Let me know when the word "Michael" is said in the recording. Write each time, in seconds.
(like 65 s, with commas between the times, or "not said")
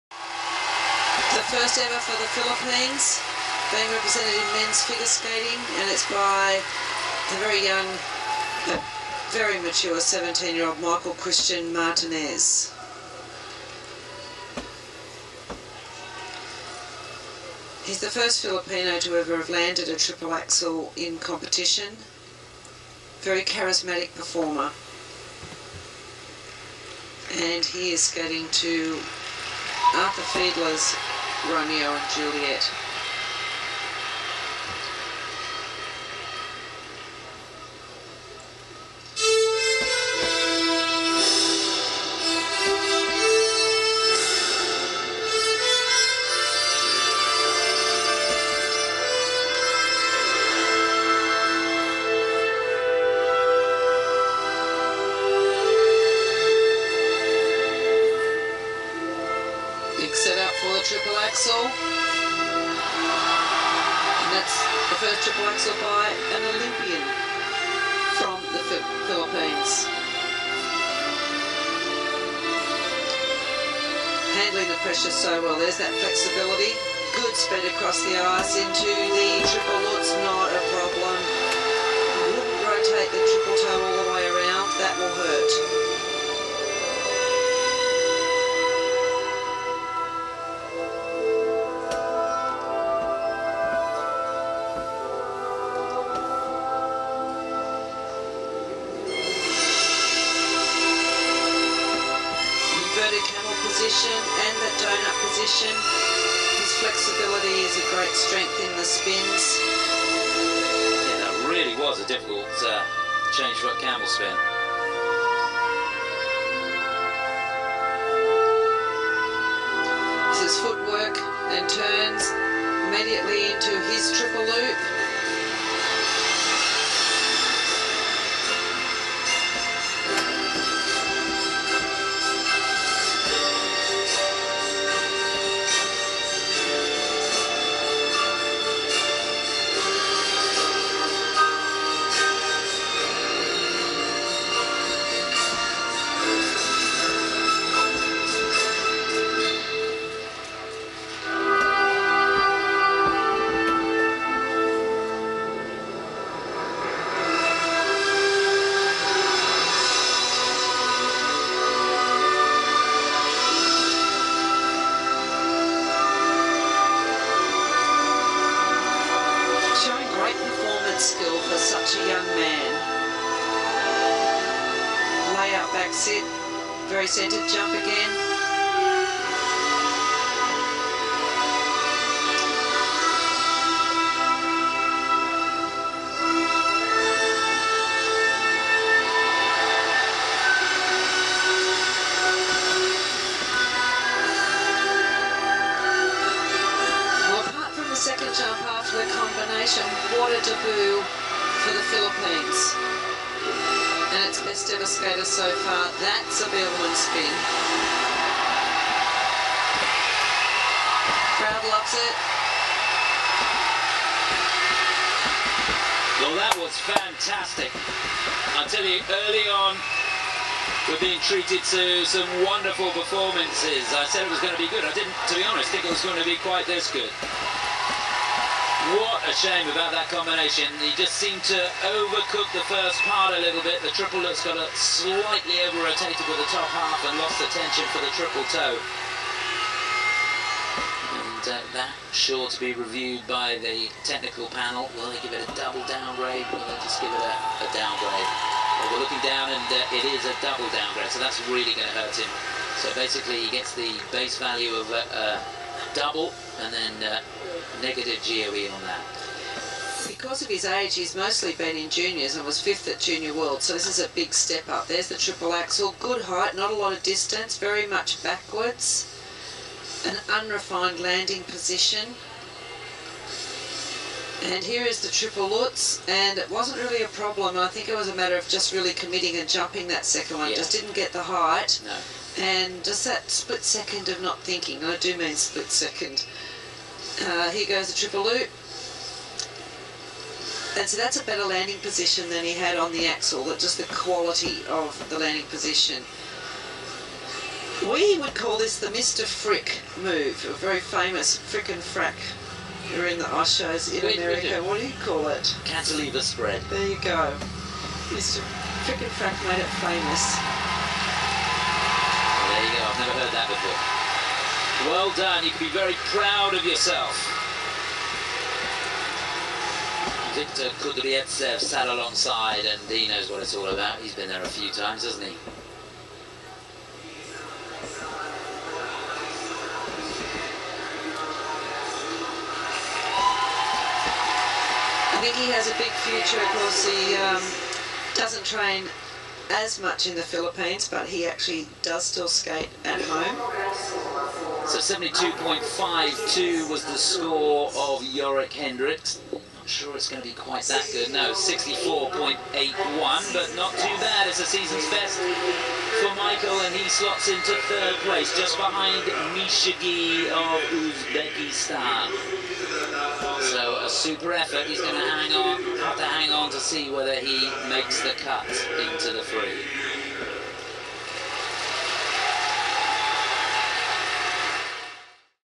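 10 s, 356 s.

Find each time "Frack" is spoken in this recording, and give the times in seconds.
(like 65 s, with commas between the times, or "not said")
301 s, 309 s.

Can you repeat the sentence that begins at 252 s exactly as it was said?
So basically he gets the base value of a, double and then...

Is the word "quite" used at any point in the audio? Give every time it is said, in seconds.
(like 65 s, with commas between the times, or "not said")
226 s, 350 s.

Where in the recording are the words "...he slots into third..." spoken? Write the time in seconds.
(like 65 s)
356 s.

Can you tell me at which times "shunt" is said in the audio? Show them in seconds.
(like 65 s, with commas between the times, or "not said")
not said.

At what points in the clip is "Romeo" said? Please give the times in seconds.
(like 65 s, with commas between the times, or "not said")
31 s.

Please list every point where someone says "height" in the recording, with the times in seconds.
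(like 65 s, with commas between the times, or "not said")
266 s, 281 s.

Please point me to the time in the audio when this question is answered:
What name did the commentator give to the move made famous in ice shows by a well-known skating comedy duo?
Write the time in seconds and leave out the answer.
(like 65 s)
305 s.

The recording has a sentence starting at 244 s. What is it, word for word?
Will they give it a double downgrade?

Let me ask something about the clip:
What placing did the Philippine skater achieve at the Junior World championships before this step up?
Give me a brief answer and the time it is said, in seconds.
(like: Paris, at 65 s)
Fifth, at 262 s.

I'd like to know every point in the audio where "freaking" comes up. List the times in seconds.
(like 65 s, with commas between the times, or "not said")
not said.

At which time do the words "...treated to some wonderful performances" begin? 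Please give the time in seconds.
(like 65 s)
221 s.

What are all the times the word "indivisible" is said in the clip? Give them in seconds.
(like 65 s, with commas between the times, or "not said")
not said.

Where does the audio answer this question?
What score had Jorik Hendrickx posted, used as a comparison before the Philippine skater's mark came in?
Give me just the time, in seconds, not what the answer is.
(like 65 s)
344 s.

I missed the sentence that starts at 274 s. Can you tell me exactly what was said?
And here is the triple Lutz, and it wasn't really a problem.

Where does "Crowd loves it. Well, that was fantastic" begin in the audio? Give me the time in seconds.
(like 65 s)
211 s.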